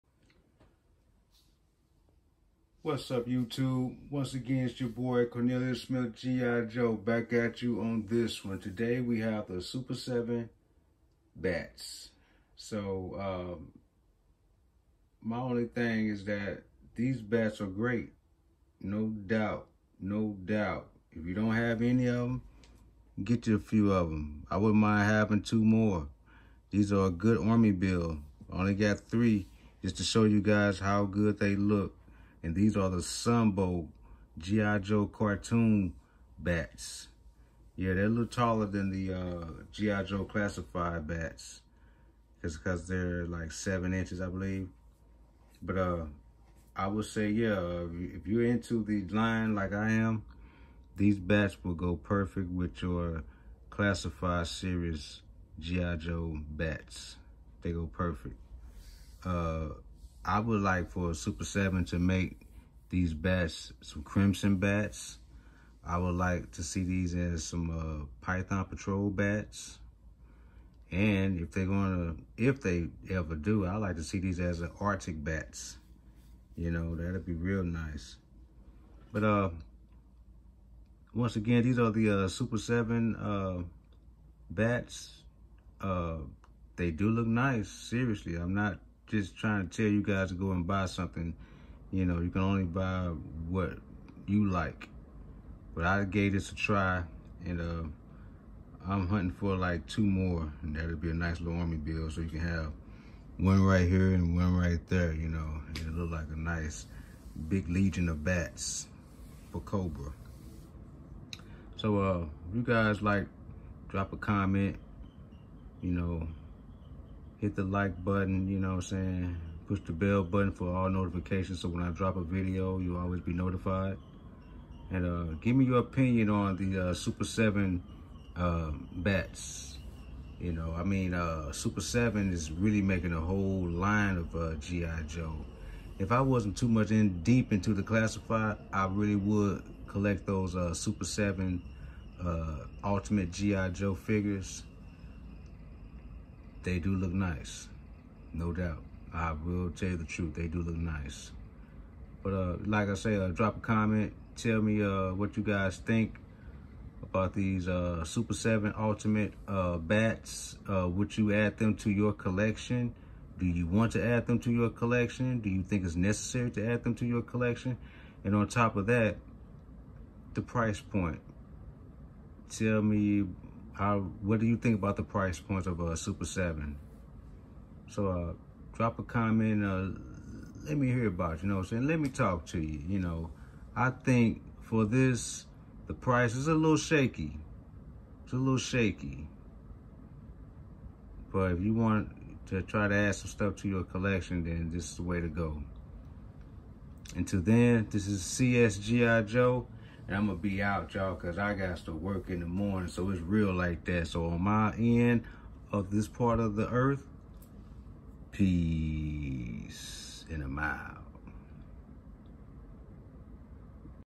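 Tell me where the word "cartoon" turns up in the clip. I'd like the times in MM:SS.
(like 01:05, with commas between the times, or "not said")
00:35.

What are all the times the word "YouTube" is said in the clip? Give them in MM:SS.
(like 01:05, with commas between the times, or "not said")
00:03.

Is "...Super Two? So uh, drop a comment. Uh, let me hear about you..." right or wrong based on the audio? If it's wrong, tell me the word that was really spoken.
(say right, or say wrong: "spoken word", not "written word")
wrong: "Seven", not "Two".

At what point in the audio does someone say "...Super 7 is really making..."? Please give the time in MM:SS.
02:11.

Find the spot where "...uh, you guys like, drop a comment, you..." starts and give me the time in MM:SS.
01:51.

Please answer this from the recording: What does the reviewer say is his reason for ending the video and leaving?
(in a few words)
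Work in the morning.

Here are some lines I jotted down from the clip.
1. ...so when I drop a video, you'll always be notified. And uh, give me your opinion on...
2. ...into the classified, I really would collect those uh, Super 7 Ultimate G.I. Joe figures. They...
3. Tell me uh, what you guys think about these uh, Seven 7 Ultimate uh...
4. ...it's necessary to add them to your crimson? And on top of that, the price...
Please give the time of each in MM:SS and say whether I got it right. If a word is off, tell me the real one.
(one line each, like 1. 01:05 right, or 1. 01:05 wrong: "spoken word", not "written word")
1. 02:01 right
2. 02:17 right
3. 02:34 wrong: "Super", not "Seven"
4. 02:45 wrong: "collection", not "crimson".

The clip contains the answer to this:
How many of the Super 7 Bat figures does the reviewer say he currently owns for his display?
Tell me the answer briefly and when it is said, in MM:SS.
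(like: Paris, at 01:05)
3, at 00:29.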